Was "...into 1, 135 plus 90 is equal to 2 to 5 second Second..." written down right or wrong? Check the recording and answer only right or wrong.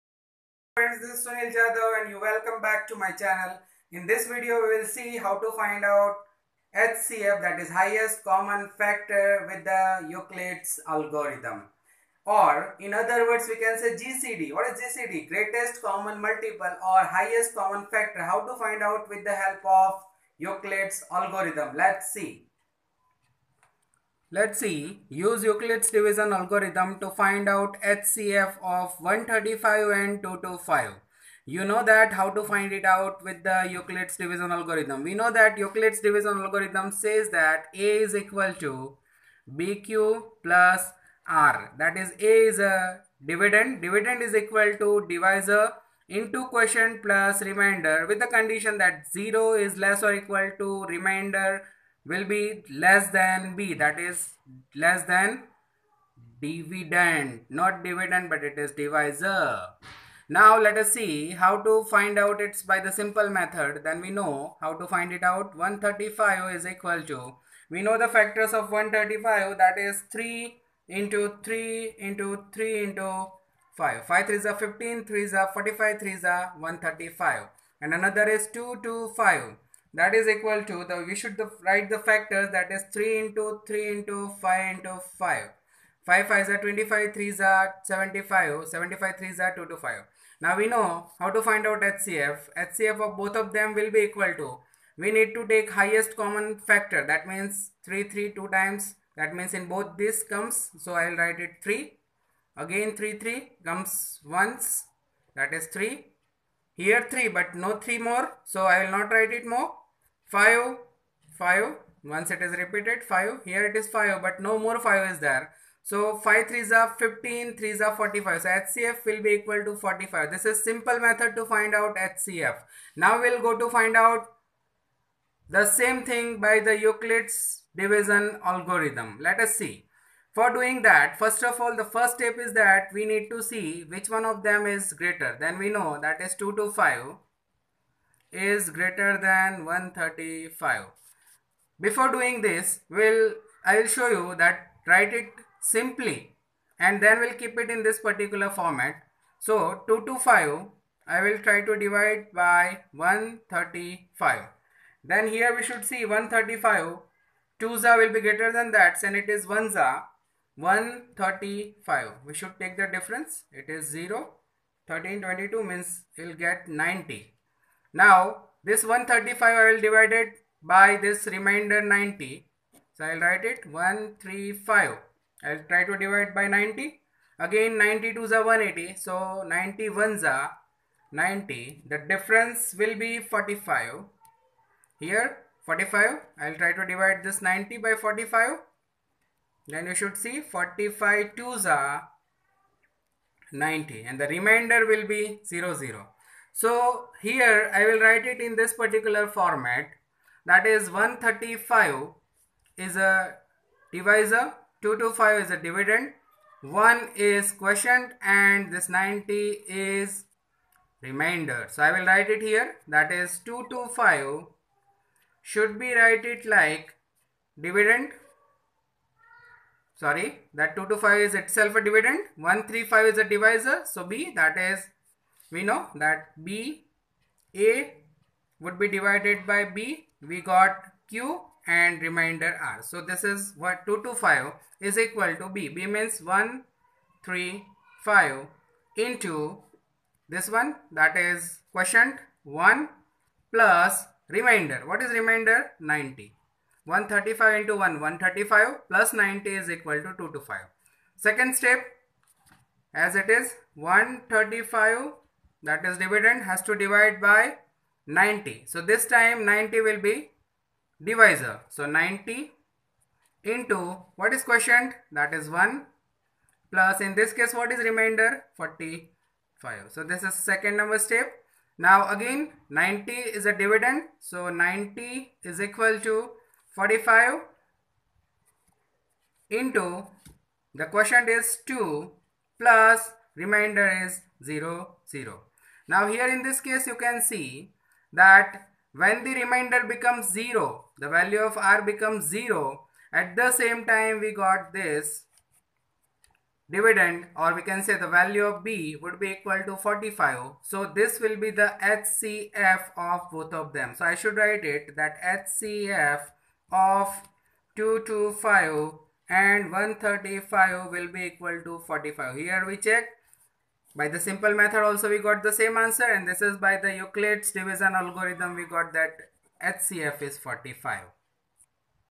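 right.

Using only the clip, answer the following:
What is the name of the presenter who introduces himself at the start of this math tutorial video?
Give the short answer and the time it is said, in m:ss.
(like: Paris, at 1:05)
Sunil Jadhav, at 0:01.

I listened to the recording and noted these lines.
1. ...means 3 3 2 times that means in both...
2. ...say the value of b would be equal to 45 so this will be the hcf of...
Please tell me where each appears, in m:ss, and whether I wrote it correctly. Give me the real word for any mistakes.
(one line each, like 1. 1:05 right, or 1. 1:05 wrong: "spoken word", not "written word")
1. 1:37 right
2. 4:57 right.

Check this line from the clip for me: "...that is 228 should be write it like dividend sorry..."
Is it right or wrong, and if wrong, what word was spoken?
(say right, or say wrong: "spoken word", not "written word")
wrong: "225", not "228".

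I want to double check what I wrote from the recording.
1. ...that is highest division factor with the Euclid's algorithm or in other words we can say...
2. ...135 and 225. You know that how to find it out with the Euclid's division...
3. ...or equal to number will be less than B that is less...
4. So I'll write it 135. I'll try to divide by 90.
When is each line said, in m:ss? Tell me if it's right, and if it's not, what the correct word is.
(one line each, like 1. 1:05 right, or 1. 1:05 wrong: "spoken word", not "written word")
1. 0:07 wrong: "common", not "division"
2. 0:29 right
3. 0:50 wrong: "remainder", not "number"
4. 2:52 right.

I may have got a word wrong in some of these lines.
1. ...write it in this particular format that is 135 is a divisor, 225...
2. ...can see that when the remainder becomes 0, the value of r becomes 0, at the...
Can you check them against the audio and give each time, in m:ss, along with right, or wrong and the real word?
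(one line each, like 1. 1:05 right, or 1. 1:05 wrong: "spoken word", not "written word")
1. 3:17 right
2. 4:46 right.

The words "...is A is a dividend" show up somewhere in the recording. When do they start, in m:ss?
0:41.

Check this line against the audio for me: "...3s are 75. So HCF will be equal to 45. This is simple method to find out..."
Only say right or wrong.
wrong.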